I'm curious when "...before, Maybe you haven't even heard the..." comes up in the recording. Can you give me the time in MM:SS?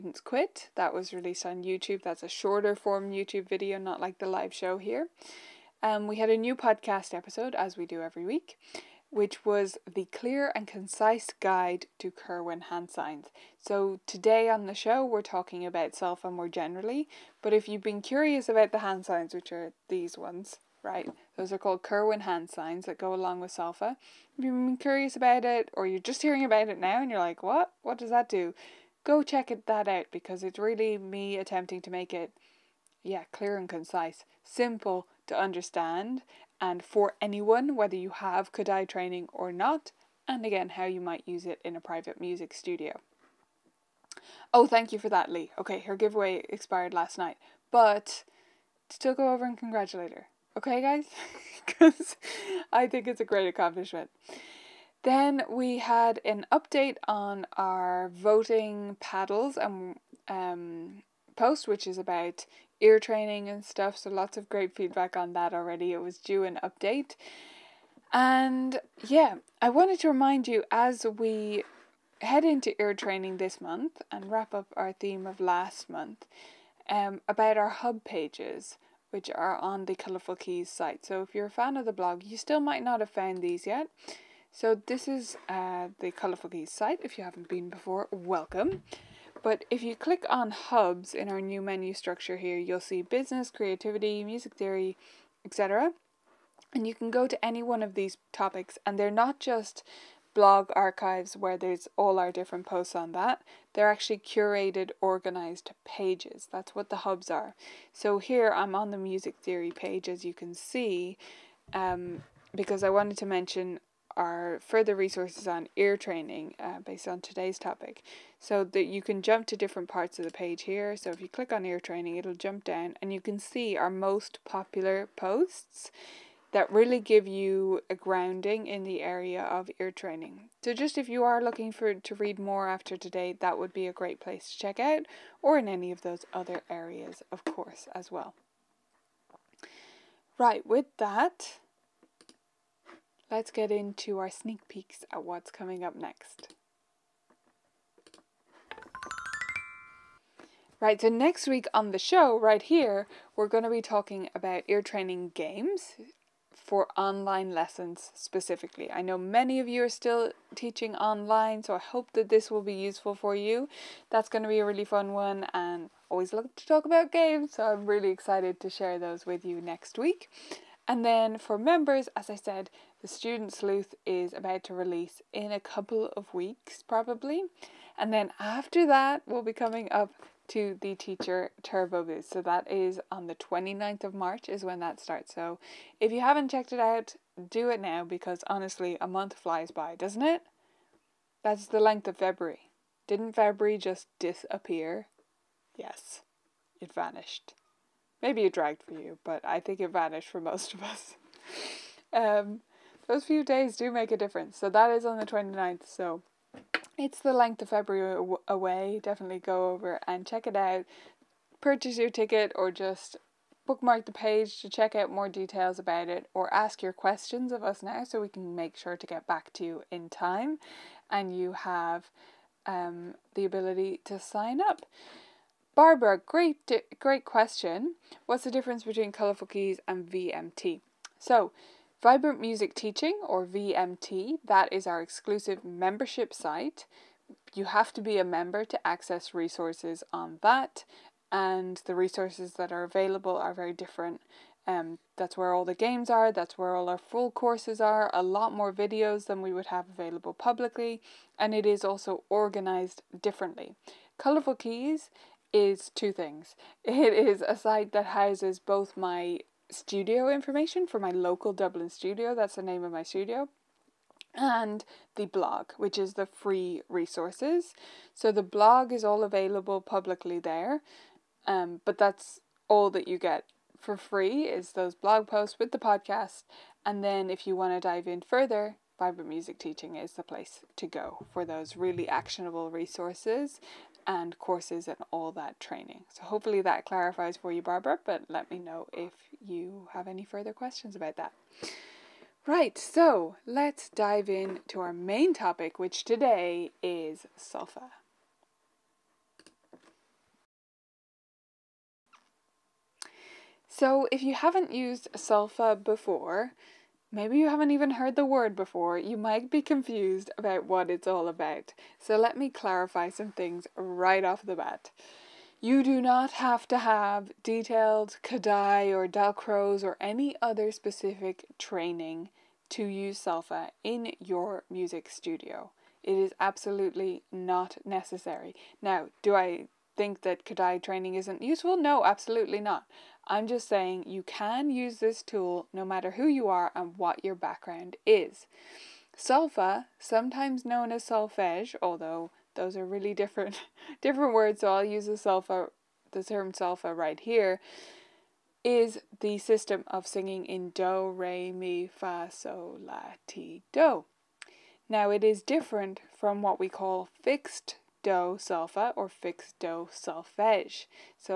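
05:05.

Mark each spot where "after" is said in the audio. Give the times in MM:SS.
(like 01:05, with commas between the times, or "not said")
02:12, 02:58.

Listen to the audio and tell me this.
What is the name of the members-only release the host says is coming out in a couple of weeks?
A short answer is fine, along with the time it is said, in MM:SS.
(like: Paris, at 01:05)
Student Sleuth, at 02:53.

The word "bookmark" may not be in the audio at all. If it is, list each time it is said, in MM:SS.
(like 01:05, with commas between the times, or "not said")
03:33.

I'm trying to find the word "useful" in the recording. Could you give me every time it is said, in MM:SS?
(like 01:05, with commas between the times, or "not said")
02:42, 05:31.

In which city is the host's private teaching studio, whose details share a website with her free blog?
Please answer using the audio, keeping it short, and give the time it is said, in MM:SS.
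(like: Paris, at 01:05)
Dublin, at 04:21.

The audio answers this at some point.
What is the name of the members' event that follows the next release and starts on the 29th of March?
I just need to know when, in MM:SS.
03:00.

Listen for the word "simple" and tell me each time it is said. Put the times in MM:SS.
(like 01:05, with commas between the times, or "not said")
00:34.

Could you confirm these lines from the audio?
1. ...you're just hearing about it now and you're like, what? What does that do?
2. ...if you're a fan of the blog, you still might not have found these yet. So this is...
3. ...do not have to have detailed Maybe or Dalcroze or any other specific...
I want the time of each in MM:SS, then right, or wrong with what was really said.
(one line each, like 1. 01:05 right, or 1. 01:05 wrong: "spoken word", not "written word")
1. 00:25 right
2. 01:21 right
3. 05:15 wrong: "Kodály", not "Maybe".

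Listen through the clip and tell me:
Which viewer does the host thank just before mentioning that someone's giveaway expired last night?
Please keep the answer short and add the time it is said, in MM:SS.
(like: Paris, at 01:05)
Lee, at 00:45.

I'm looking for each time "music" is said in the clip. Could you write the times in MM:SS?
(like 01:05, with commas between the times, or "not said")
00:42, 01:34, 01:48, 03:52, 04:39, 05:24.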